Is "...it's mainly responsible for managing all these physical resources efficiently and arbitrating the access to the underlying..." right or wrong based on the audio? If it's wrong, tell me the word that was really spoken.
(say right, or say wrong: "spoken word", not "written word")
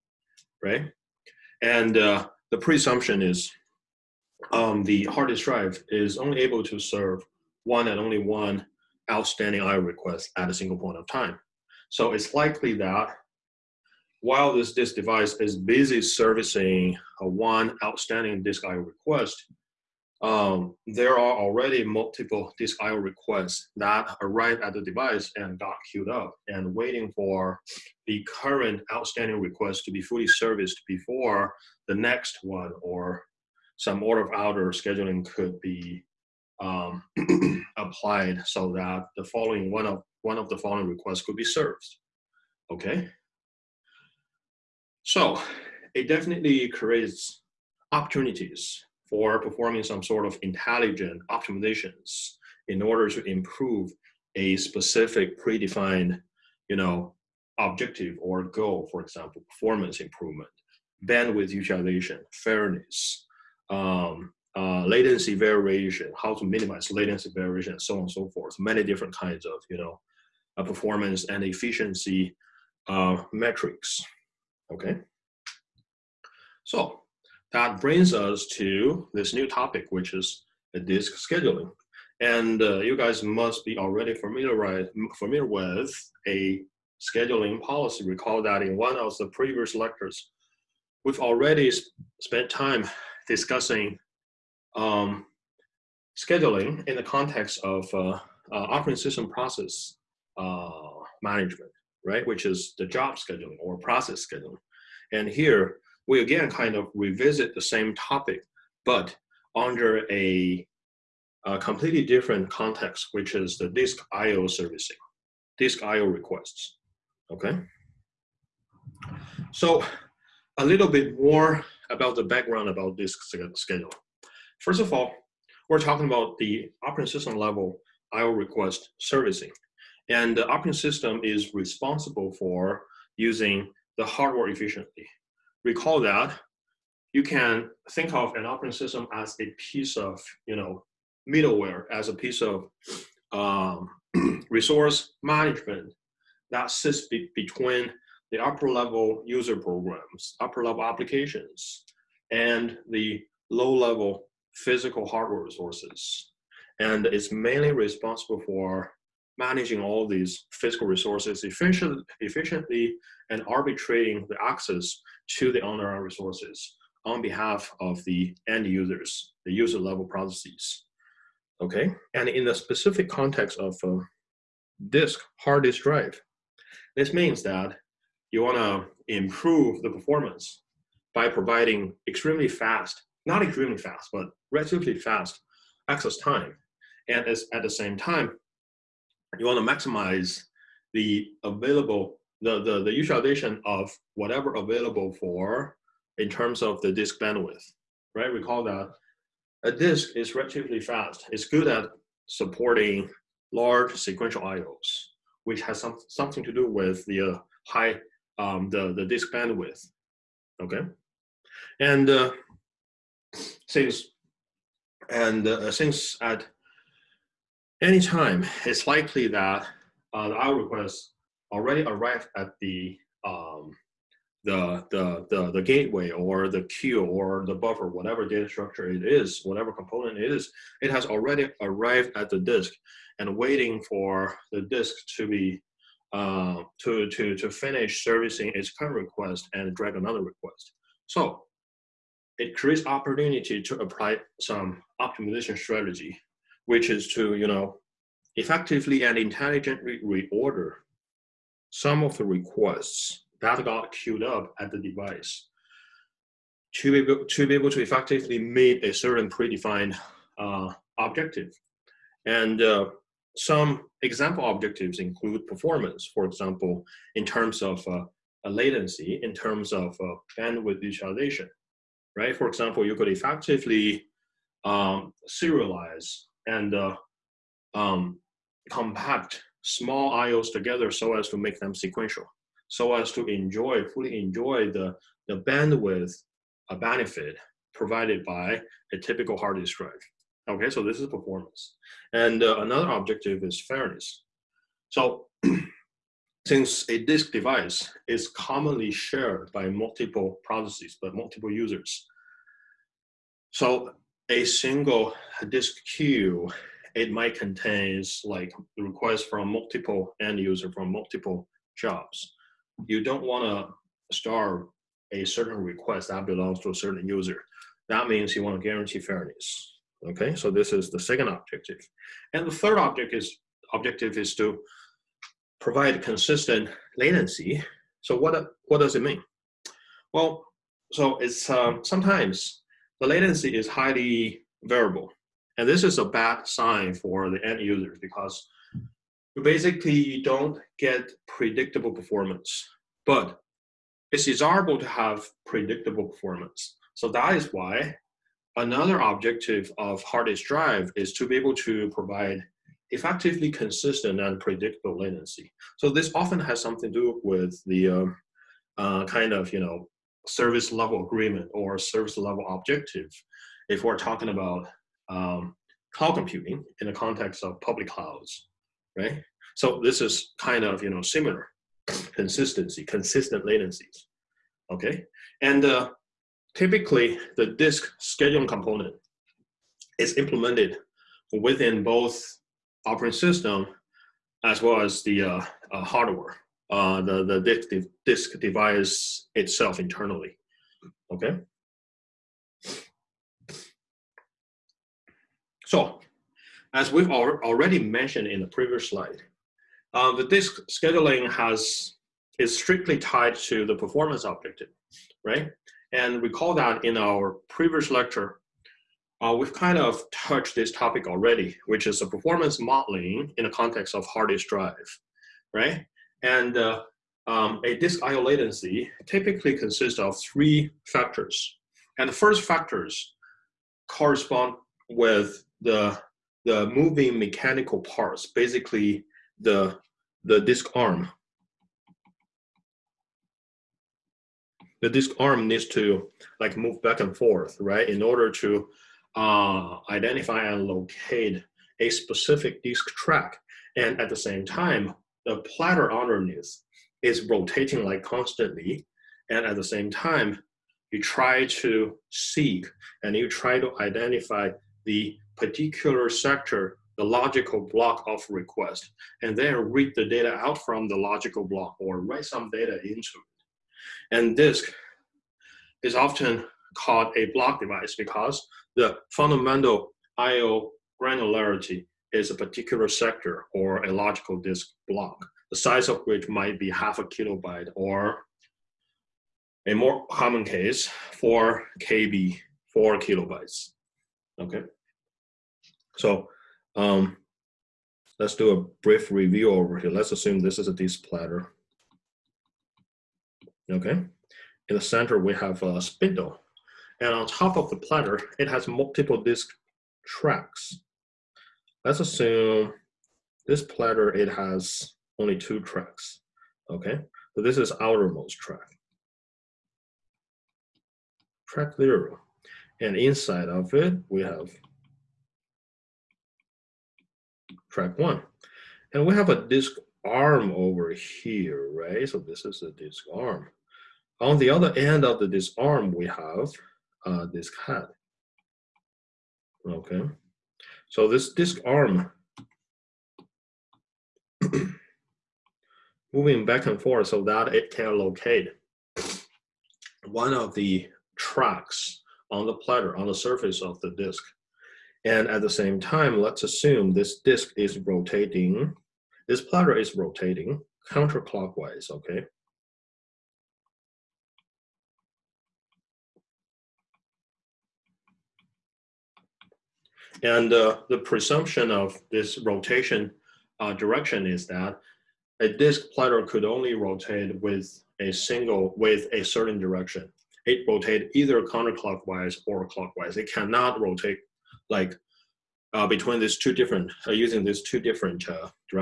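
right.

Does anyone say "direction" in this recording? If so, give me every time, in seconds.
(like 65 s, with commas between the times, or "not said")
563 s, 569 s.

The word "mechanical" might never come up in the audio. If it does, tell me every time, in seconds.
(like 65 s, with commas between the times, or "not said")
427 s.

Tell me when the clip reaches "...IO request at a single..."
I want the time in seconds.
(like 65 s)
9 s.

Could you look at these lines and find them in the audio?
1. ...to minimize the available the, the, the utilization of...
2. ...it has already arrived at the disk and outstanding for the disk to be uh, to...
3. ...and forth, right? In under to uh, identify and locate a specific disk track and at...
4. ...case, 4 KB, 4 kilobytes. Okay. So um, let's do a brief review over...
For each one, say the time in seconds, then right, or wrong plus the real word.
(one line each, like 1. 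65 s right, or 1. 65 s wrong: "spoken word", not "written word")
1. 189 s wrong: "maximize", not "minimize"
2. 230 s wrong: "waiting", not "outstanding"
3. 436 s wrong: "order", not "under"
4. 480 s right.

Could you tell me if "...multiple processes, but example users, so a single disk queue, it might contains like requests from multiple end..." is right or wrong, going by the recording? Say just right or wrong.
wrong.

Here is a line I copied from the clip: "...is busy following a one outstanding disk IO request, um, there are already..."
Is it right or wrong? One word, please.
wrong.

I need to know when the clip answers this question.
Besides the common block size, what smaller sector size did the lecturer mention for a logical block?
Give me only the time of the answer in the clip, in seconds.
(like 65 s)
476 s.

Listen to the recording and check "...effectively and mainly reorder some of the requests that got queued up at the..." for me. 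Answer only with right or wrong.
wrong.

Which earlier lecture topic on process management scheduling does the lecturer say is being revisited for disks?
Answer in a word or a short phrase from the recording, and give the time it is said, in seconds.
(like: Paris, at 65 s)
job scheduling, at 102 s.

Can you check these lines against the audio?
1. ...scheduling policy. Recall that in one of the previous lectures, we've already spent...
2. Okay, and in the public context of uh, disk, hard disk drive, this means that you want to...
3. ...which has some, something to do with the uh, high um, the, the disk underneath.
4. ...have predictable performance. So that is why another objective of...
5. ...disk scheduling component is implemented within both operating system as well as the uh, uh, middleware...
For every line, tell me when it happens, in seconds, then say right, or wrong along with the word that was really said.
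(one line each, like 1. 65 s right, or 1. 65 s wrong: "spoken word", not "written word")
1. 86 s right
2. 171 s wrong: "specific", not "public"
3. 205 s wrong: "bandwidth", not "underneath"
4. 344 s right
5. 377 s wrong: "hardware", not "middleware".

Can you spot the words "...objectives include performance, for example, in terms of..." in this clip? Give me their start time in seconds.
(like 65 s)
264 s.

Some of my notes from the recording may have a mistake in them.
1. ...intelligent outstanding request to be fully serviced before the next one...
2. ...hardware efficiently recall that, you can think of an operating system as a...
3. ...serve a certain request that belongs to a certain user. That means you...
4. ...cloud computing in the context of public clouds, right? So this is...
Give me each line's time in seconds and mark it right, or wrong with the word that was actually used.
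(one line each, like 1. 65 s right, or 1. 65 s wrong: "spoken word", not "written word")
1. 28 s wrong: "current", not "intelligent"
2. 134 s right
3. 314 s wrong: "starve", not "serve"
4. 365 s right.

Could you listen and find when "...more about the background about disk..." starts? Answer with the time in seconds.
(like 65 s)
121 s.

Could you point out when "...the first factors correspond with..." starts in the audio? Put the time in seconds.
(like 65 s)
422 s.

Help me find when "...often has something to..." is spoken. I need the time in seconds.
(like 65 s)
356 s.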